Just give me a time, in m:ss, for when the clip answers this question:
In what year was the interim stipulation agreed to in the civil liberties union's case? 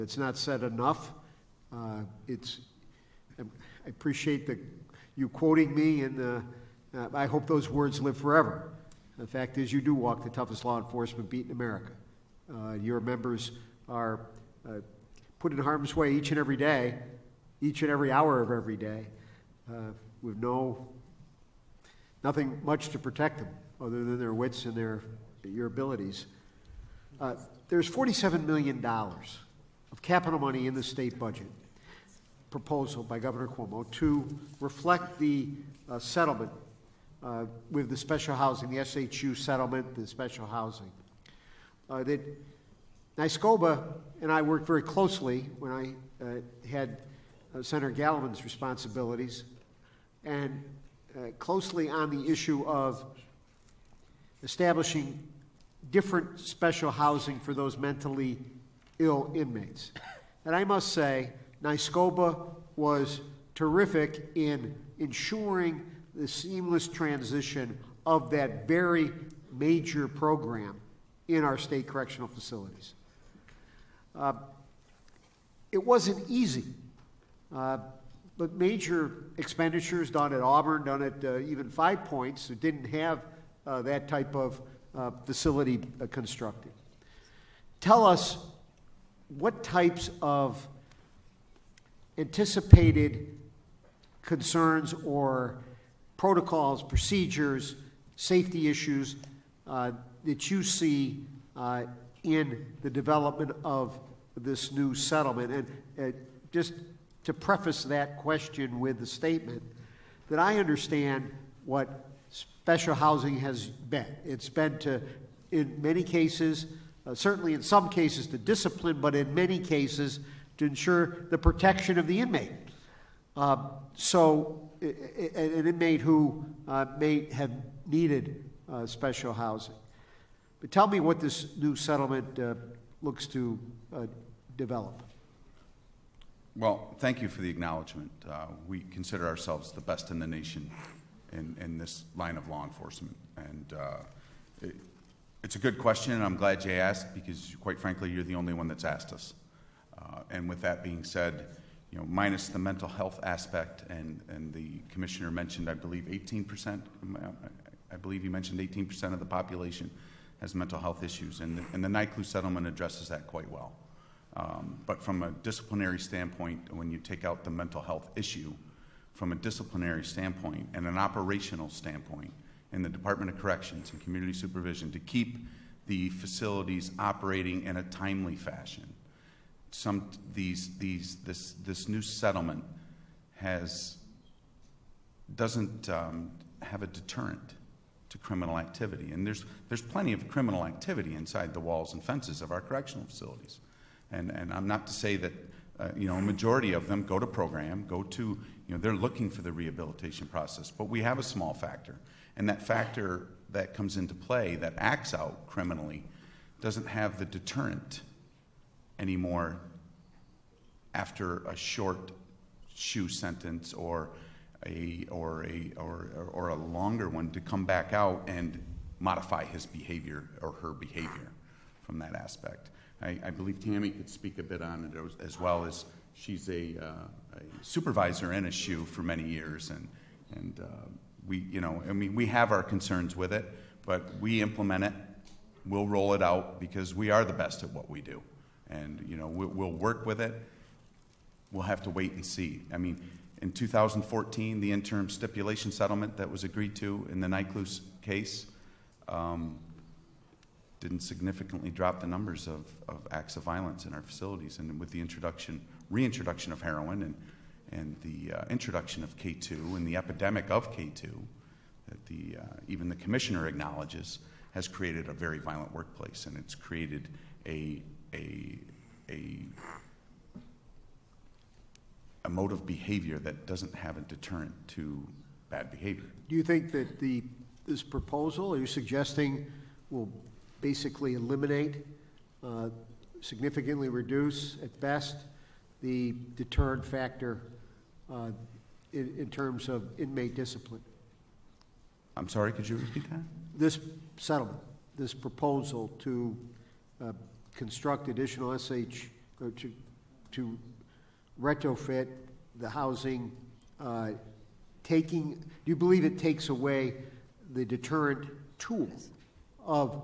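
4:03.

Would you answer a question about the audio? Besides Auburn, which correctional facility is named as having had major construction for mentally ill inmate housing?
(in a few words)
Five Points.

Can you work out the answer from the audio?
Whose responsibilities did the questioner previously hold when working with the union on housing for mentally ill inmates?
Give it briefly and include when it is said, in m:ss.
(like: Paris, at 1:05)
Gallivan, at 0:47.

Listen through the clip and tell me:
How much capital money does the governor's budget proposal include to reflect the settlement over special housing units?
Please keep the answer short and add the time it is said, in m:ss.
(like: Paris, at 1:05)
$47 million, at 0:27.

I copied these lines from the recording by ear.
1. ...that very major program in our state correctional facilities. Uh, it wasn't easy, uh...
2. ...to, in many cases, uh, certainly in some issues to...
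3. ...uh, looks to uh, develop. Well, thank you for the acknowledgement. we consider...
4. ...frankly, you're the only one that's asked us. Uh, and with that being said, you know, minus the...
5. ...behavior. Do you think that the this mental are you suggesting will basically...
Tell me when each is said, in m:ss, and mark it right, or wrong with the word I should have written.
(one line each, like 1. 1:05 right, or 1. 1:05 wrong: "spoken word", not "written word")
1. 1:08 right
2. 1:54 wrong: "cases", not "issues"
3. 2:12 right
4. 2:27 right
5. 4:35 wrong: "proposal", not "mental".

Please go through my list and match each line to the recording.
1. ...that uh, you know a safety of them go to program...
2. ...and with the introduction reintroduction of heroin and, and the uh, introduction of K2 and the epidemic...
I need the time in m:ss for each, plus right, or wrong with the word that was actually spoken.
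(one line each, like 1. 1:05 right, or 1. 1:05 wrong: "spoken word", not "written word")
1. 3:15 wrong: "majority", not "safety"
2. 4:14 right.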